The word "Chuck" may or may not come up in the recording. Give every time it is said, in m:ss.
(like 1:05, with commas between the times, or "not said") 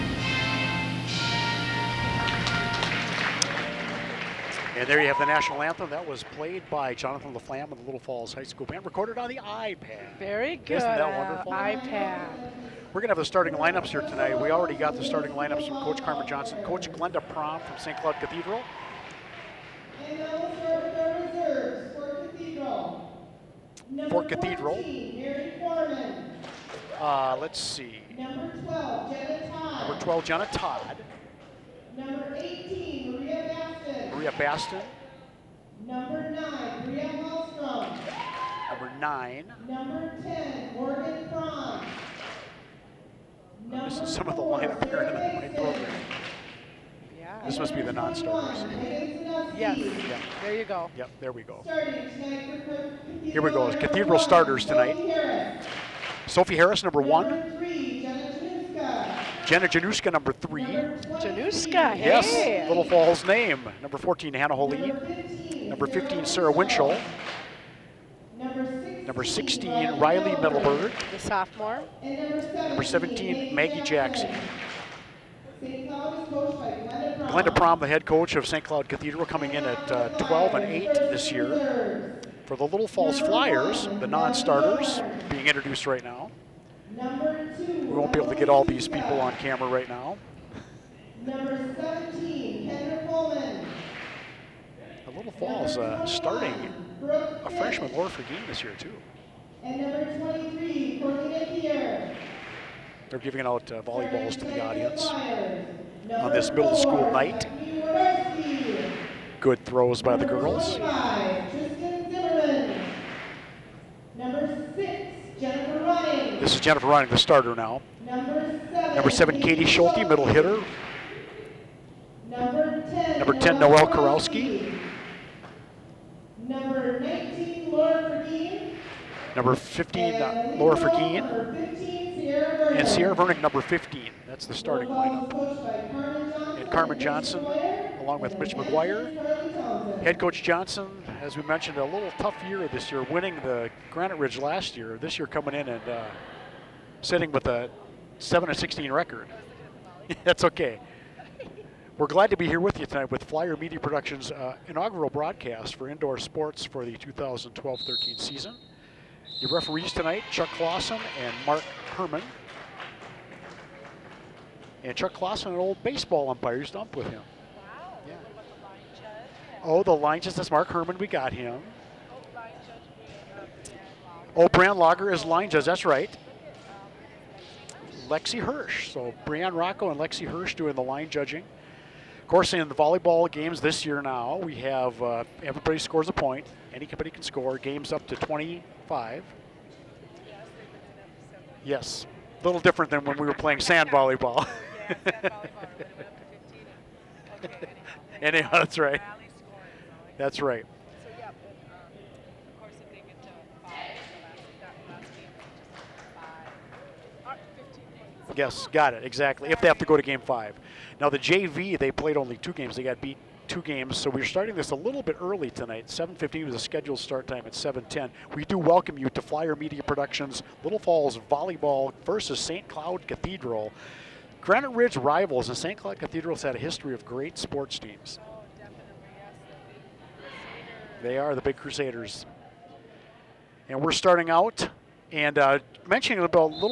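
2:40, 2:44.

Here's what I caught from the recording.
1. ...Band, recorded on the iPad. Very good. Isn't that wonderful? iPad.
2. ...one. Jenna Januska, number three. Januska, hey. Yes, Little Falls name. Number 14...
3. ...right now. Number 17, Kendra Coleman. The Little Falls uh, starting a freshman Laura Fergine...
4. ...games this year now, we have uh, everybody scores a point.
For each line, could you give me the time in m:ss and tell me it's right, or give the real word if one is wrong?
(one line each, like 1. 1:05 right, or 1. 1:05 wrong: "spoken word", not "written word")
1. 0:08 right
2. 0:57 right
3. 1:29 right
4. 3:03 right.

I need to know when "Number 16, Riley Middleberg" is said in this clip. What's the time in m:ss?
1:08.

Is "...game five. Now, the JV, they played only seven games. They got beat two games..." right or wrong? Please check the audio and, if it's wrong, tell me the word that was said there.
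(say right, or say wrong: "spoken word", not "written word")
wrong: "two", not "seven".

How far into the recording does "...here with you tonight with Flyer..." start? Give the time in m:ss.
2:32.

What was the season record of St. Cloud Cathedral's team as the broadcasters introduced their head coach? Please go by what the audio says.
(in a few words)
12-8.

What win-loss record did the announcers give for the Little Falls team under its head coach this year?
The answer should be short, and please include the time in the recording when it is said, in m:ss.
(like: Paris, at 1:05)
7-16, at 2:28.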